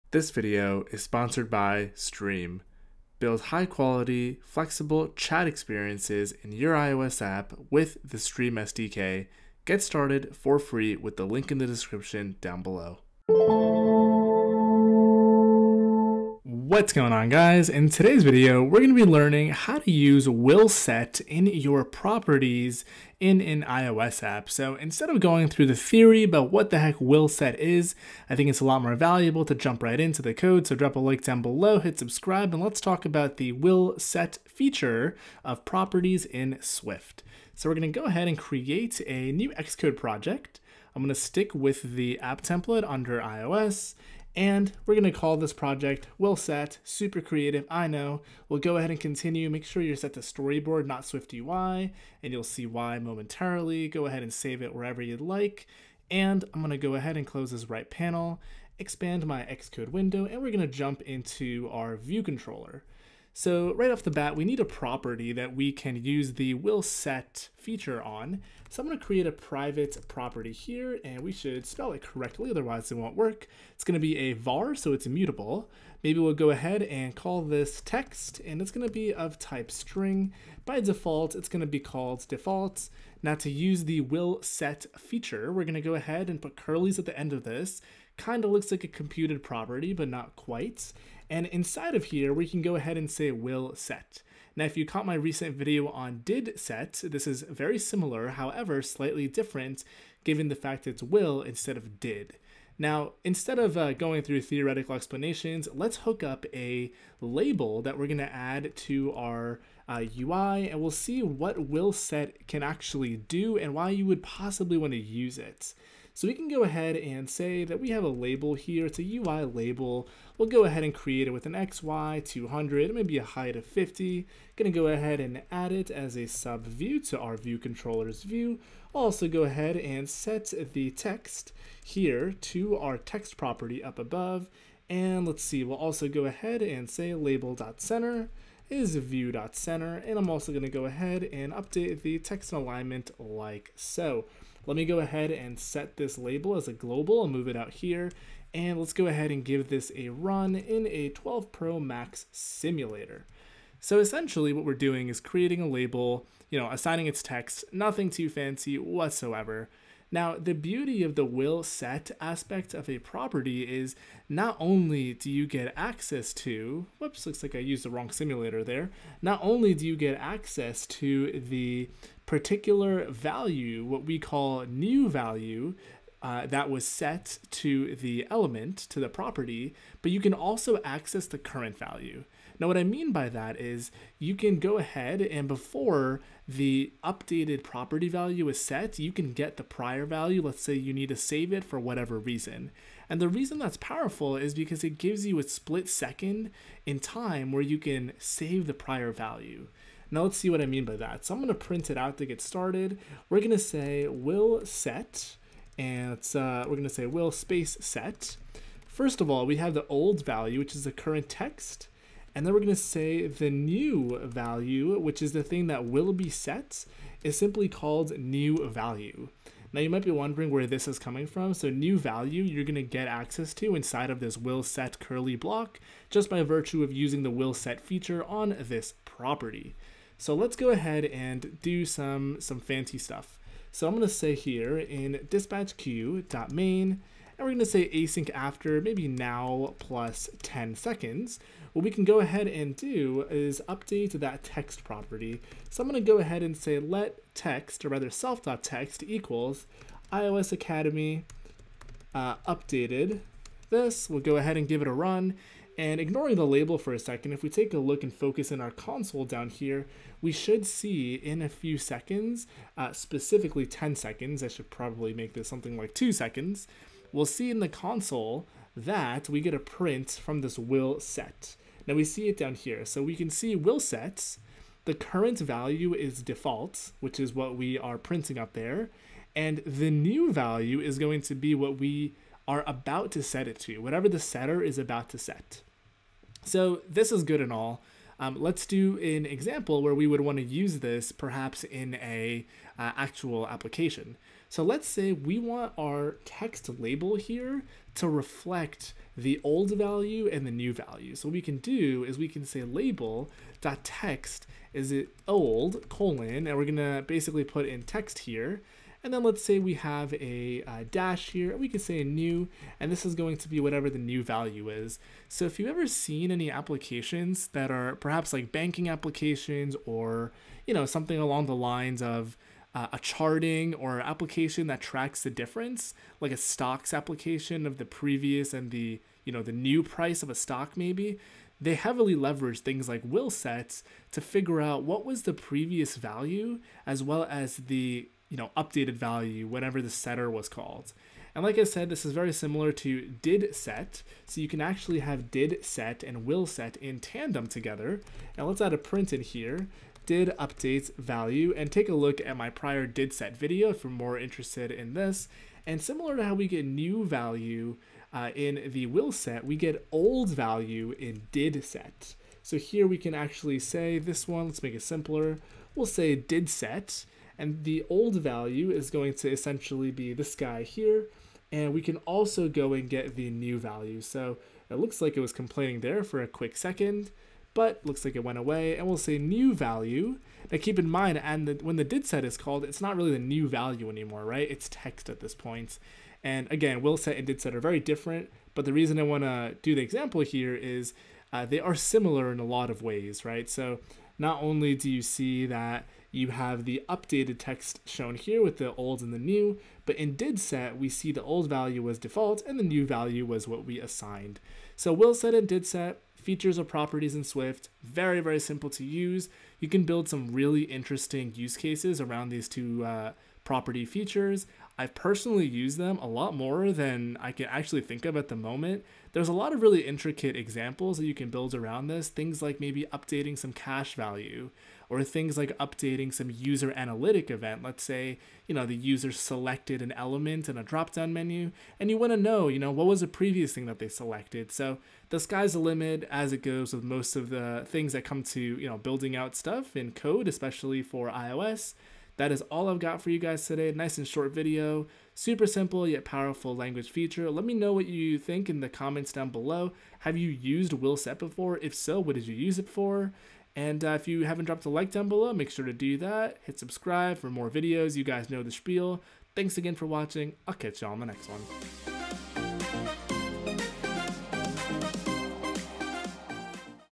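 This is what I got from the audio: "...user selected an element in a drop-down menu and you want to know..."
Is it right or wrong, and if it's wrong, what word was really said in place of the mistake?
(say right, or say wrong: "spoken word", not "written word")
right.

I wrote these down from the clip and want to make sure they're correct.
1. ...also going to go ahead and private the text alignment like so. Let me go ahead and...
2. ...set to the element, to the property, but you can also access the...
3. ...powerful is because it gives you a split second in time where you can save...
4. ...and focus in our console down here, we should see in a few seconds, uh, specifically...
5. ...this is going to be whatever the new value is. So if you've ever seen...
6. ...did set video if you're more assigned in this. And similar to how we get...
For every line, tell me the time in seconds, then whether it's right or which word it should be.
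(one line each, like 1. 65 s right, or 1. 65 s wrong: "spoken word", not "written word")
1. 140 s wrong: "update", not "private"
2. 176 s right
3. 193 s right
4. 258 s right
5. 312 s right
6. 352 s wrong: "interested", not "assigned".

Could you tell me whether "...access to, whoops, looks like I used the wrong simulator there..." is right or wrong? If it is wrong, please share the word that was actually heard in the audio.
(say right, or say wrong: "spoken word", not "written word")
right.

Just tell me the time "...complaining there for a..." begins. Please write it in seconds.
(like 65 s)
375 s.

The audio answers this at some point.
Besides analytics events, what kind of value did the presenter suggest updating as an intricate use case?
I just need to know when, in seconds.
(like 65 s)
423 s.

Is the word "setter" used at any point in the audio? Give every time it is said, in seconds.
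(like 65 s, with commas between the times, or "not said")
284 s, 339 s.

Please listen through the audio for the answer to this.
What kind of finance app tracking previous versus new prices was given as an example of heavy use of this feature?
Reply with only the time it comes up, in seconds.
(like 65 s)
326 s.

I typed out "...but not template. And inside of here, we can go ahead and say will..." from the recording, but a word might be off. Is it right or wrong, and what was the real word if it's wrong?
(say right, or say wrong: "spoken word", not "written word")
wrong: "quite", not "template".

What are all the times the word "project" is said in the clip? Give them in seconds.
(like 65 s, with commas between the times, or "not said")
39 s, 45 s.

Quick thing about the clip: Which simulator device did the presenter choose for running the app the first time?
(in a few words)
12 Pro Max.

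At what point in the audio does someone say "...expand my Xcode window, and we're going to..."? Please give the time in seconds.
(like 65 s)
58 s.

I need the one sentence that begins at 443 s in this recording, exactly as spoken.
Nice and short video, super simple yet powerful language feature.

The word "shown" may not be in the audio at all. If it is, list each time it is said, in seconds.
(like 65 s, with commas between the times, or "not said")
397 s.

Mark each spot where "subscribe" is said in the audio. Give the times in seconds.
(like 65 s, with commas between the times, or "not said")
31 s, 456 s.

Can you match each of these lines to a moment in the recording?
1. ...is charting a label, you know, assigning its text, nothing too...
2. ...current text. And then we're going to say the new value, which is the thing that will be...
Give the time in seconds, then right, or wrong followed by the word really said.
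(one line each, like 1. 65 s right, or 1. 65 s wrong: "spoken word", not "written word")
1. 155 s wrong: "creating", not "charting"
2. 210 s right.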